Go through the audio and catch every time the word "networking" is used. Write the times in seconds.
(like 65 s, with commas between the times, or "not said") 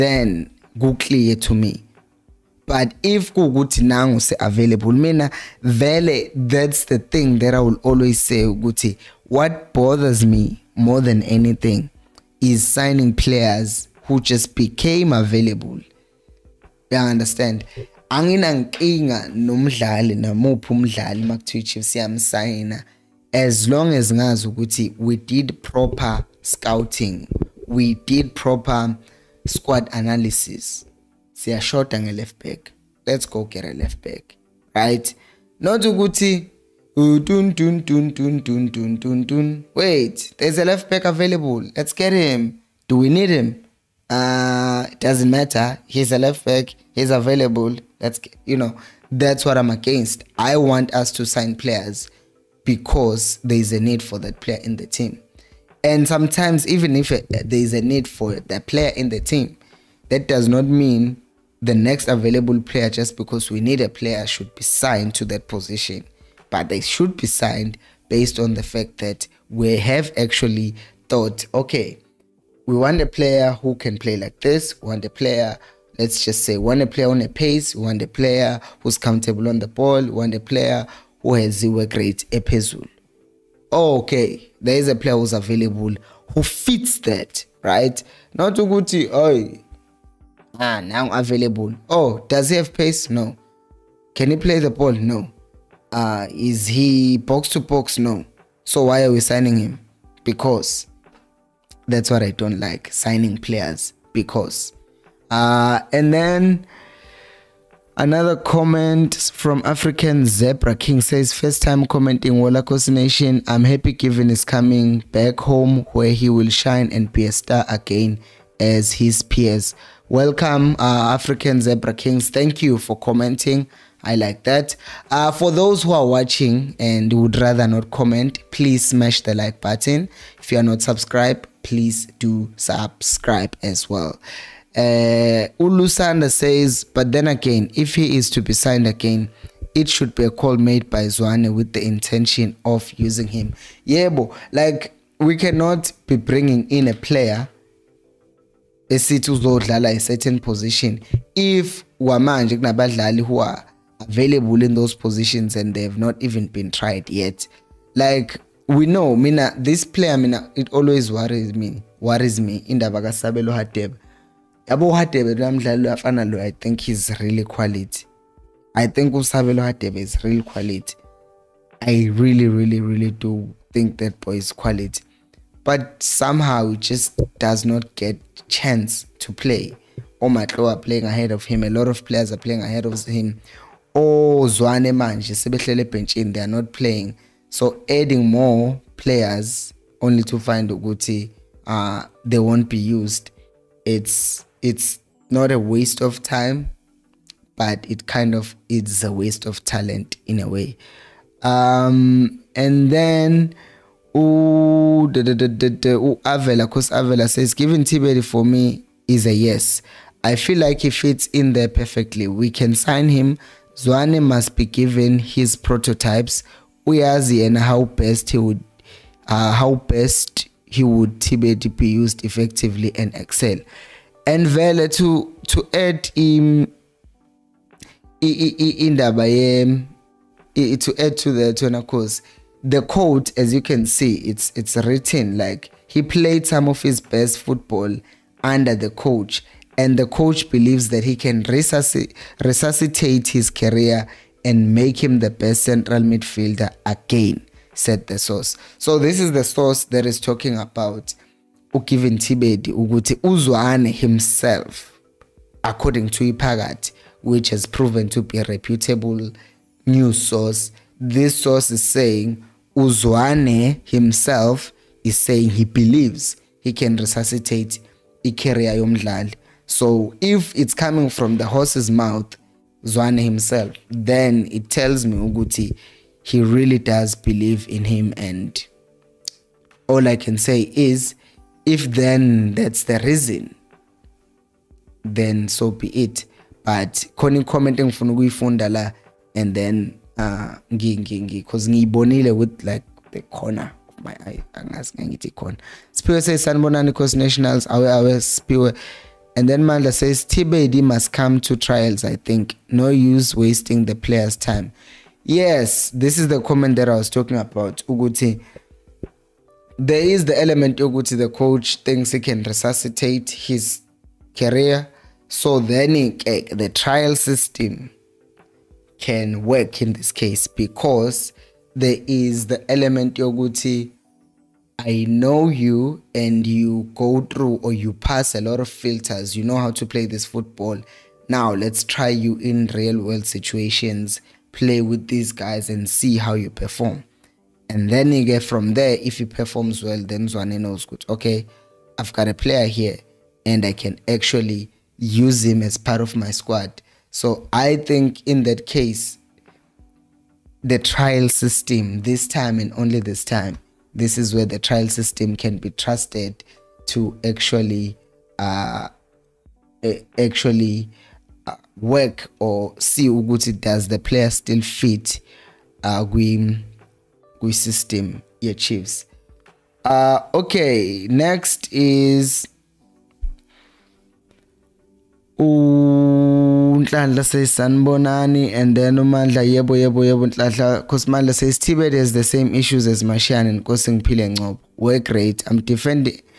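not said.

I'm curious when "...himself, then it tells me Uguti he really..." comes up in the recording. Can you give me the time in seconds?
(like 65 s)
273 s.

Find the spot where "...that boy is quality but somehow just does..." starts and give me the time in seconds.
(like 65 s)
173 s.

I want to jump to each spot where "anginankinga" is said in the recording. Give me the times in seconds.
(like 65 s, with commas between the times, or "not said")
18 s.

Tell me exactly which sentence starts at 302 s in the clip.
No use wasting the player's time.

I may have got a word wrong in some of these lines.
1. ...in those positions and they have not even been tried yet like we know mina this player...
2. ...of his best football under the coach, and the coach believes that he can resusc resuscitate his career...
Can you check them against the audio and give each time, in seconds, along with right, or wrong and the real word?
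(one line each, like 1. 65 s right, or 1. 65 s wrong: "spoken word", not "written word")
1. 154 s right
2. 236 s right.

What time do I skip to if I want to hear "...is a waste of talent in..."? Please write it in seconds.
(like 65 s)
198 s.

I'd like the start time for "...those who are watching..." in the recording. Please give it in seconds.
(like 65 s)
125 s.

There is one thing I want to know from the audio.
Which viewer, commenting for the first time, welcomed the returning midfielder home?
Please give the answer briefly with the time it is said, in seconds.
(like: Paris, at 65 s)
African Zebra King, at 109 s.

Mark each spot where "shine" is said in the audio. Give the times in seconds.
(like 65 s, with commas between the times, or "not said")
116 s.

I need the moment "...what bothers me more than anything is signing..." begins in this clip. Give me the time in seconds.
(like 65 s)
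9 s.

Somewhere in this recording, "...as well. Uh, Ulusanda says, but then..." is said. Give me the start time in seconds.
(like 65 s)
133 s.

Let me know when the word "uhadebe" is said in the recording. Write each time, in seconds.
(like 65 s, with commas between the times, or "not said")
164 s.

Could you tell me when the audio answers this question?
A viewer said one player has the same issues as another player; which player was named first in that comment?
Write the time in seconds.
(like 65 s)
383 s.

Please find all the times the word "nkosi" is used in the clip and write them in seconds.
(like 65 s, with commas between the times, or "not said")
383 s.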